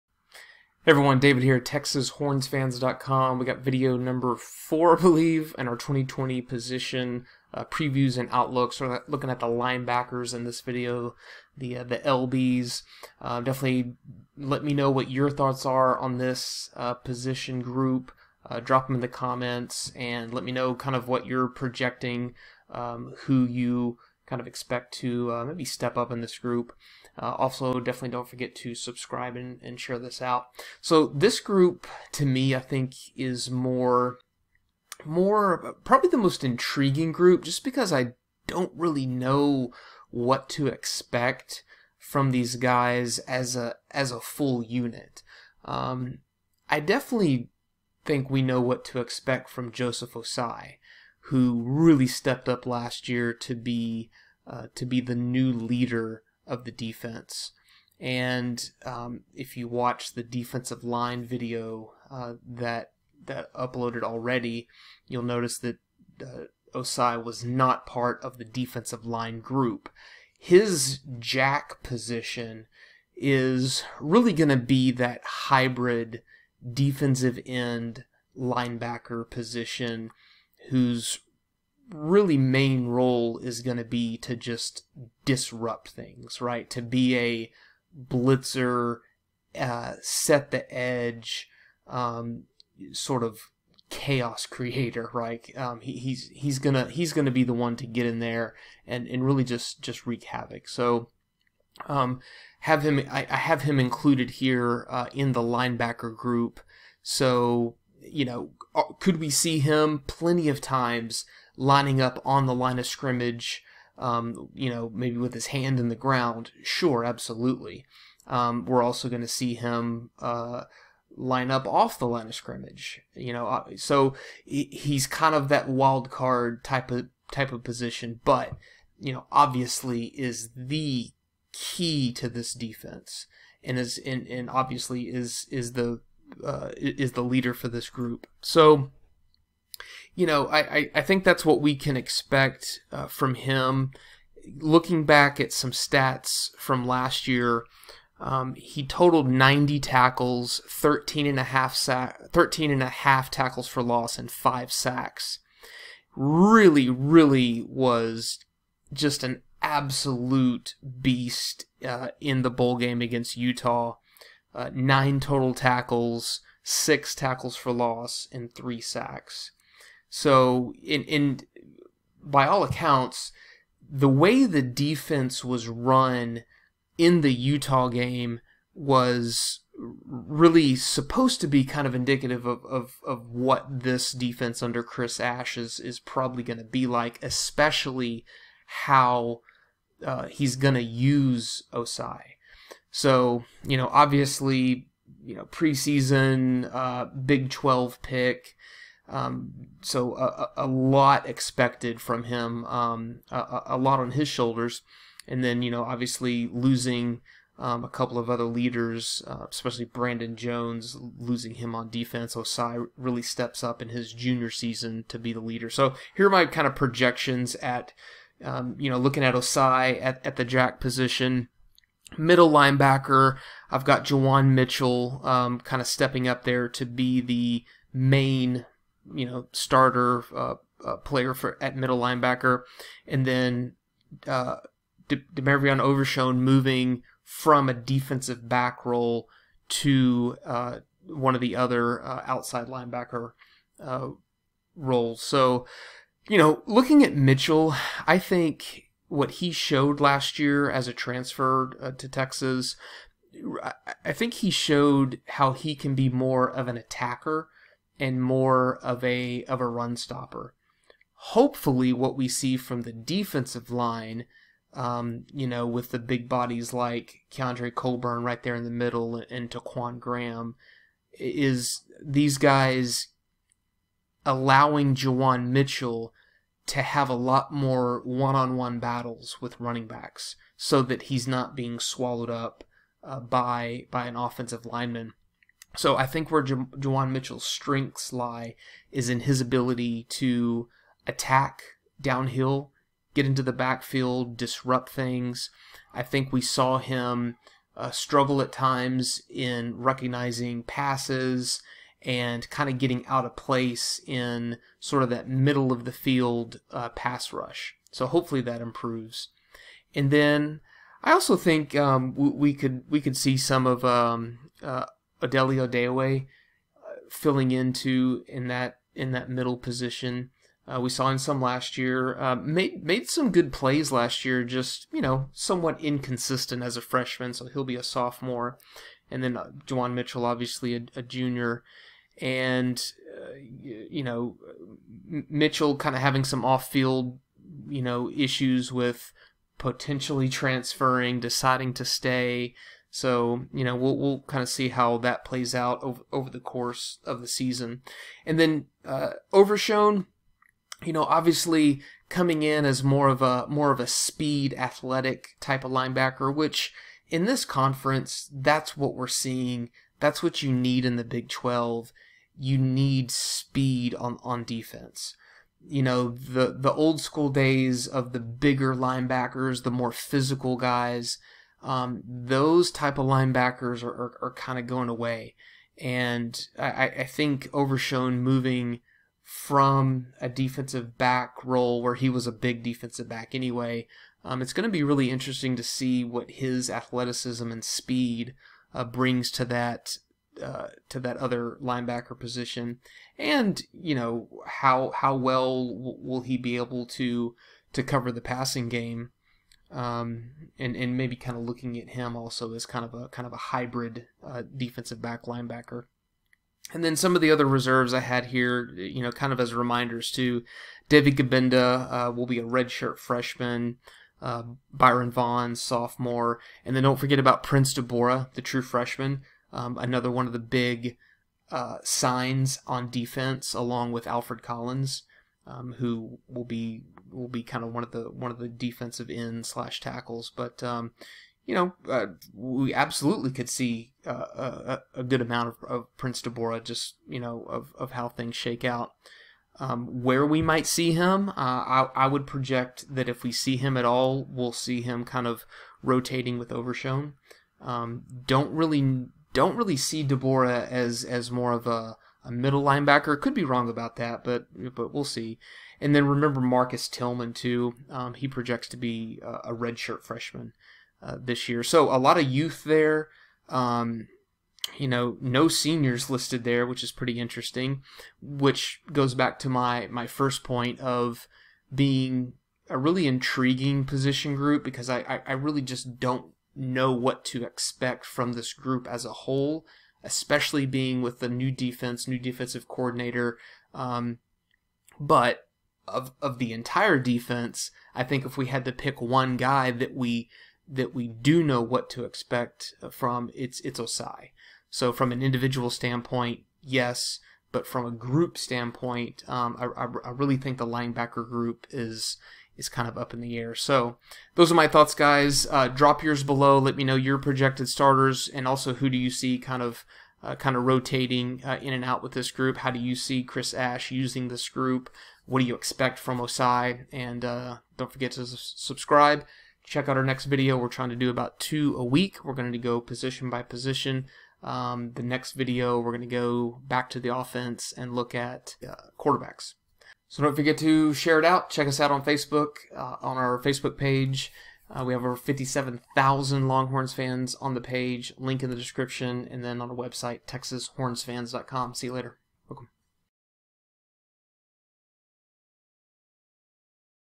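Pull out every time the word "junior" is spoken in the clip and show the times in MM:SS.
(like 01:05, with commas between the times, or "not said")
03:34, 05:31.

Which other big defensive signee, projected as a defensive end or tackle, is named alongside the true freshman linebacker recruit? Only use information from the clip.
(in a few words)
Alfred Collins.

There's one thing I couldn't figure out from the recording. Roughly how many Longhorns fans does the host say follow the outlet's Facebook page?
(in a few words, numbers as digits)
57,000.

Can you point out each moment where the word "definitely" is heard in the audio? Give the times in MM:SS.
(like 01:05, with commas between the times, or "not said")
00:13, 00:27, 00:46.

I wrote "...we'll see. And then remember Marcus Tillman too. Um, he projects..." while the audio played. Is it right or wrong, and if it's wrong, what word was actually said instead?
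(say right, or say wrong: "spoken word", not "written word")
right.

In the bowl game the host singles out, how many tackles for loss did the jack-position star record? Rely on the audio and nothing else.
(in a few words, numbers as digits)
6.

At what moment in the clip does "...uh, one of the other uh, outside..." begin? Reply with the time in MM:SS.
04:00.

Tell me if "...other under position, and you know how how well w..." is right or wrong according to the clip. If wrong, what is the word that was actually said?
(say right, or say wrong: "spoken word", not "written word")
wrong: "linebacker", not "under".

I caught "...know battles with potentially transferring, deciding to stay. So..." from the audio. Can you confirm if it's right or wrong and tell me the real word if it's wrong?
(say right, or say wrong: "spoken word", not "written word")
wrong: "issues", not "battles".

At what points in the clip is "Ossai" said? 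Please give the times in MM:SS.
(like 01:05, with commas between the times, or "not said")
00:50, 01:06, 03:11, 03:32, 03:39, 08:13, 08:36.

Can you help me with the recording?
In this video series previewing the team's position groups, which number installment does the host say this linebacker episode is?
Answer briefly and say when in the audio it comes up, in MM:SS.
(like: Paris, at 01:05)
4, at 00:04.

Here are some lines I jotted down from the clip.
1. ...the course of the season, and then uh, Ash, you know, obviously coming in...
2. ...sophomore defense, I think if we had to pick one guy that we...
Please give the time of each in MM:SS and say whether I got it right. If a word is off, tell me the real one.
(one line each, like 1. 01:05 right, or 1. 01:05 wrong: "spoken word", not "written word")
1. 05:46 wrong: "Overshown", not "Ash"
2. 08:06 wrong: "entire", not "sophomore".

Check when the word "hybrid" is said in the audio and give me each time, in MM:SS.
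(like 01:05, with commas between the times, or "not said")
01:15, 06:43.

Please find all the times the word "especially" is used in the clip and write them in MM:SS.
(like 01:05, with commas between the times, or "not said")
03:07, 03:29, 08:00.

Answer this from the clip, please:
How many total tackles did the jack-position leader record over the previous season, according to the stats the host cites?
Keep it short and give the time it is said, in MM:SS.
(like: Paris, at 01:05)
90, at 02:29.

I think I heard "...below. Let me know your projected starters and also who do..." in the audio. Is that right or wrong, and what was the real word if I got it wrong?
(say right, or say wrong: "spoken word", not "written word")
right.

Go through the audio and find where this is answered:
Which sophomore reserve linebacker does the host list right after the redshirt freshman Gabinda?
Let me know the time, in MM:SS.
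06:54.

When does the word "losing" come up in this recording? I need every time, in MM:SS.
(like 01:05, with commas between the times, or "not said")
03:26, 03:31.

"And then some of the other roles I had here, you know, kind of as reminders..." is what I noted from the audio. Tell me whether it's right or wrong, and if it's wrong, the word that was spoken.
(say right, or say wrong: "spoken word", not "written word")
wrong: "reserves", not "roles".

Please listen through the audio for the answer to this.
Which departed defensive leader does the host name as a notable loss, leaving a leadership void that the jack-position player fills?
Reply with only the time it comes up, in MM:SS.
03:29.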